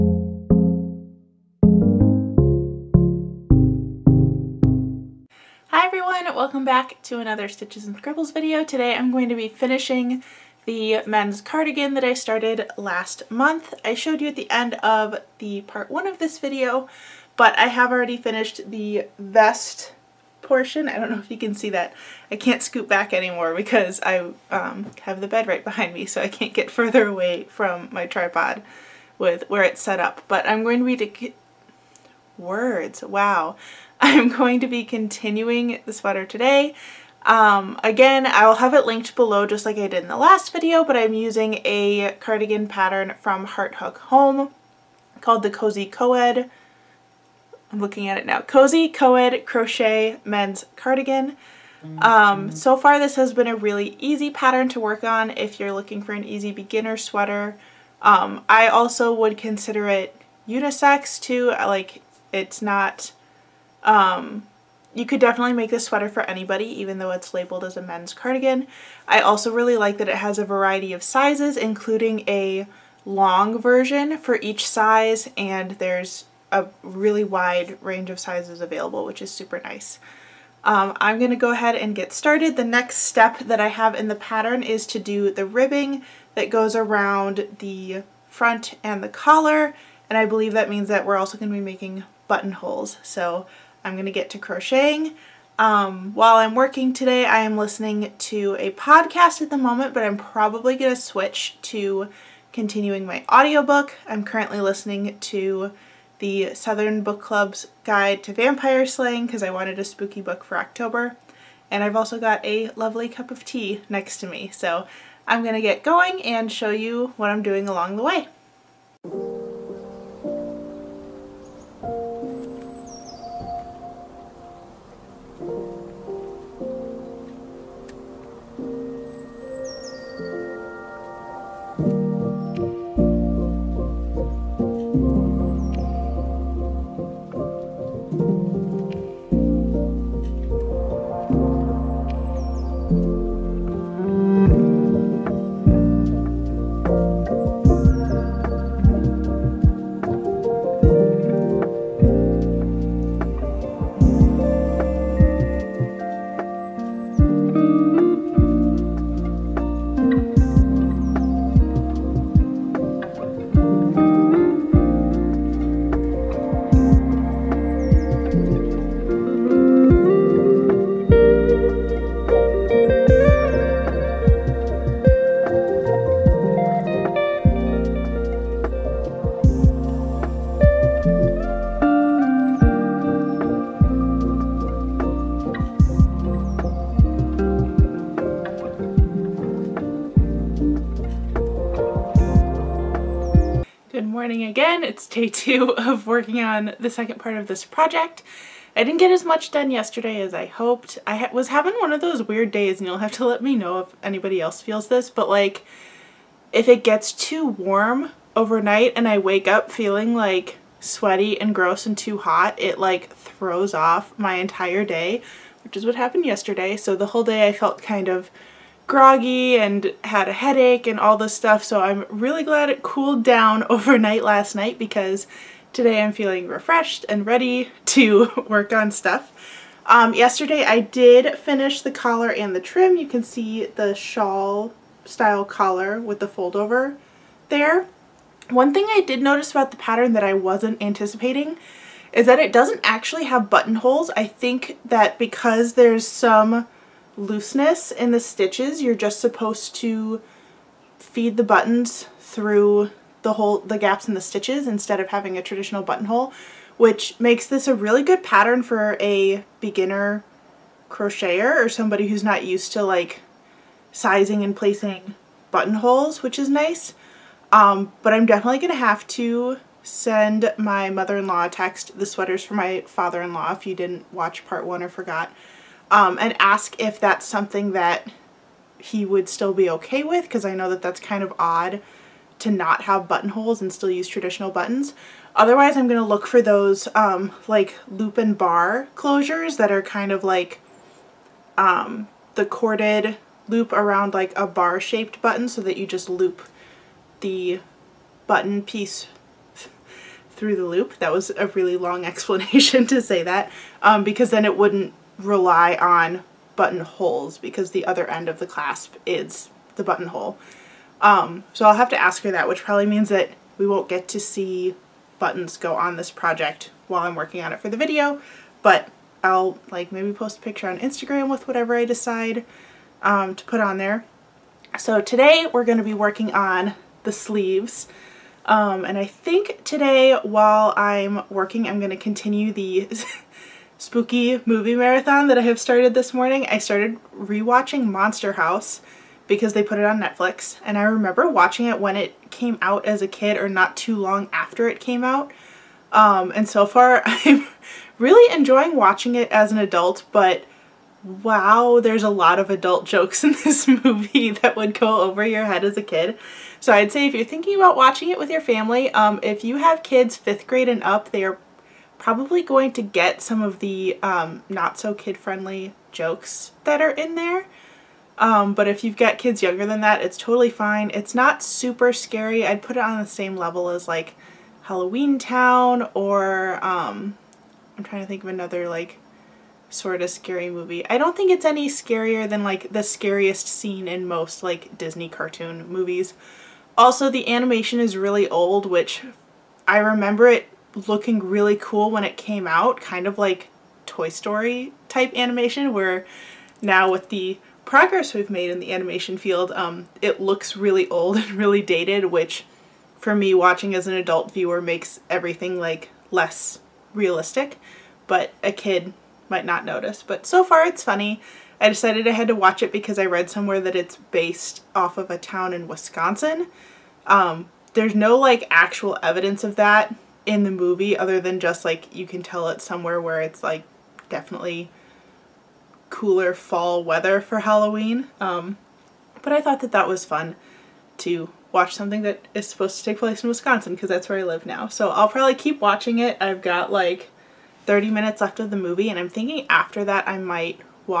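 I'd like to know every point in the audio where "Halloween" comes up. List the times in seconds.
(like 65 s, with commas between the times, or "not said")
374 s, 427 s.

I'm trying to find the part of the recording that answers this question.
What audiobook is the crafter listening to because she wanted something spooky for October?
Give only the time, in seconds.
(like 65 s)
106 s.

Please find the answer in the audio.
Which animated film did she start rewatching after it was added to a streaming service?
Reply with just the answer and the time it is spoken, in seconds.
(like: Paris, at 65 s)
Monster House, at 337 s.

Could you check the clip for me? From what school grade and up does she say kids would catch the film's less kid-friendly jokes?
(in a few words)
Fifth grade.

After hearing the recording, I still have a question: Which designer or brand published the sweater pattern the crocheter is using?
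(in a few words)
Heart Hook Home.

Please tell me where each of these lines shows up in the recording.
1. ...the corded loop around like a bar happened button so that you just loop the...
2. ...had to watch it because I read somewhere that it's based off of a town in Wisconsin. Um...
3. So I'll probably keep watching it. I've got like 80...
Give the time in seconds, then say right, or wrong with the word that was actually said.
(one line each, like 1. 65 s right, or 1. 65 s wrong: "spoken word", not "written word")
1. 292 s wrong: "shaped", not "happened"
2. 412 s right
3. 434 s wrong: "30", not "80".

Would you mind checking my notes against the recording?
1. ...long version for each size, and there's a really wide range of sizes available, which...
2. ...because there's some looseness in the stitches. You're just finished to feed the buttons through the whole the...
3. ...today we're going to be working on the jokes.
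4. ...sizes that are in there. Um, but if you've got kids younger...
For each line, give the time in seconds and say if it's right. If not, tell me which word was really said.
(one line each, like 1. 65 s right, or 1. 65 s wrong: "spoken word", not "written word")
1. 73 s right
2. 245 s wrong: "supposed", not "finished"
3. 325 s wrong: "sleeves", not "jokes"
4. 365 s wrong: "jokes", not "sizes".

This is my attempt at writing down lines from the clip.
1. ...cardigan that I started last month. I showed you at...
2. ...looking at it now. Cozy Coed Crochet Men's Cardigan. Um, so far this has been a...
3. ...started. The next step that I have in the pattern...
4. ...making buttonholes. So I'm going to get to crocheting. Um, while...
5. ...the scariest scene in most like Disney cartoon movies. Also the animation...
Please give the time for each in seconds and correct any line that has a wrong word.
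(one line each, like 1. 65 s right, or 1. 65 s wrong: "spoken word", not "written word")
1. 11 s right
2. 47 s right
3. 82 s right
4. 91 s right
5. 382 s right.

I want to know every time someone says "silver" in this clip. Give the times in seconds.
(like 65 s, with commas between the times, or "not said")
not said.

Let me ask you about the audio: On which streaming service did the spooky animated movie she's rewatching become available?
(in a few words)
Netflix.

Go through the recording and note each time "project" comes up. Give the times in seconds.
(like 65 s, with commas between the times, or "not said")
197 s, 316 s.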